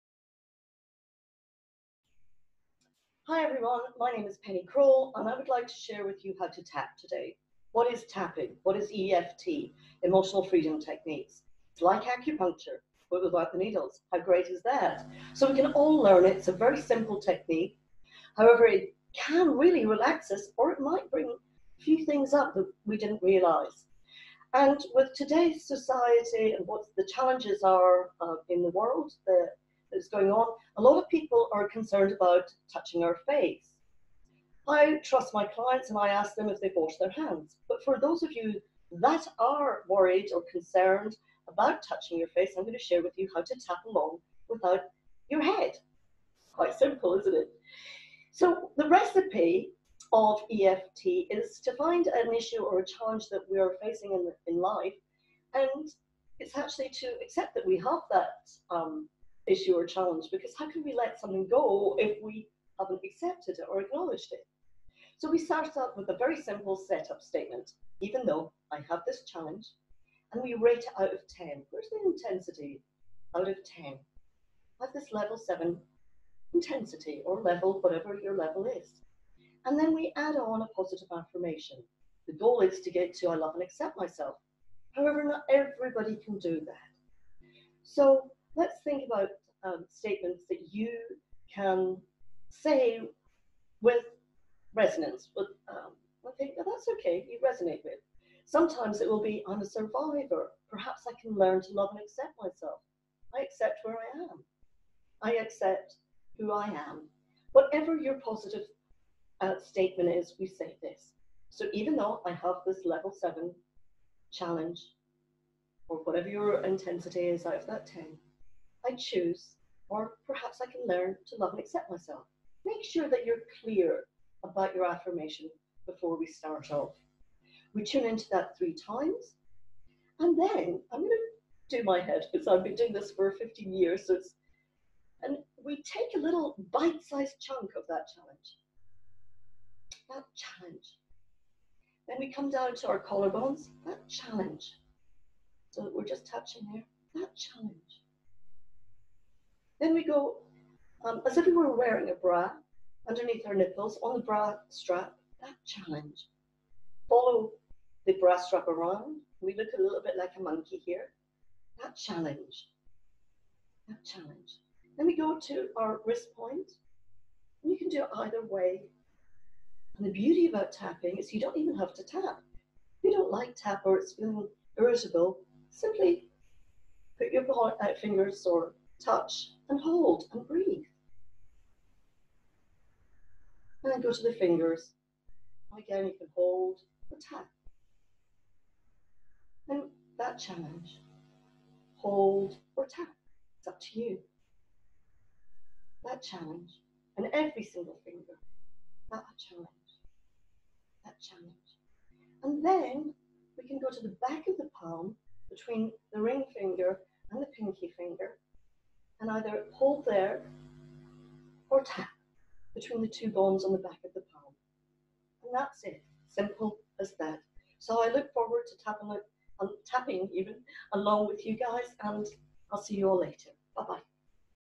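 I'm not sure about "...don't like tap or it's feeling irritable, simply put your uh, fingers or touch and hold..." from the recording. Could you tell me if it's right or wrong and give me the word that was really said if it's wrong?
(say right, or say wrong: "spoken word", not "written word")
right.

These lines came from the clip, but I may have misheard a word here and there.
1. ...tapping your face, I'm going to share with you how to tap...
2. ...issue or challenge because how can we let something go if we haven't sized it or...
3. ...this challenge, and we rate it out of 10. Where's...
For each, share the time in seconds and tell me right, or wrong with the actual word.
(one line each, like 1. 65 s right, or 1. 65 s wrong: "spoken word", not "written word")
1. 41 s wrong: "touching", not "tapping"
2. 59 s wrong: "accepted", not "sized"
3. 69 s right.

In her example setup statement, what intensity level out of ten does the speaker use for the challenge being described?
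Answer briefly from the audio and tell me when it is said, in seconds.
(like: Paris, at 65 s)
7, at 75 s.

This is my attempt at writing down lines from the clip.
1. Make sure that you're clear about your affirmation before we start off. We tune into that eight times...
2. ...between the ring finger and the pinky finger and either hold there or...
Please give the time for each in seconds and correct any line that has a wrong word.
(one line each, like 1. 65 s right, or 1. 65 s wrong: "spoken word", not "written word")
1. 122 s wrong: "three", not "eight"
2. 205 s right.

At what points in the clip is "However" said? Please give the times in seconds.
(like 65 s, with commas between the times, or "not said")
18 s, 84 s.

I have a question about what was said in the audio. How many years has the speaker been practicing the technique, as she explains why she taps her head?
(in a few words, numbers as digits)
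15.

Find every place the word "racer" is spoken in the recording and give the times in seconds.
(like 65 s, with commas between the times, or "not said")
not said.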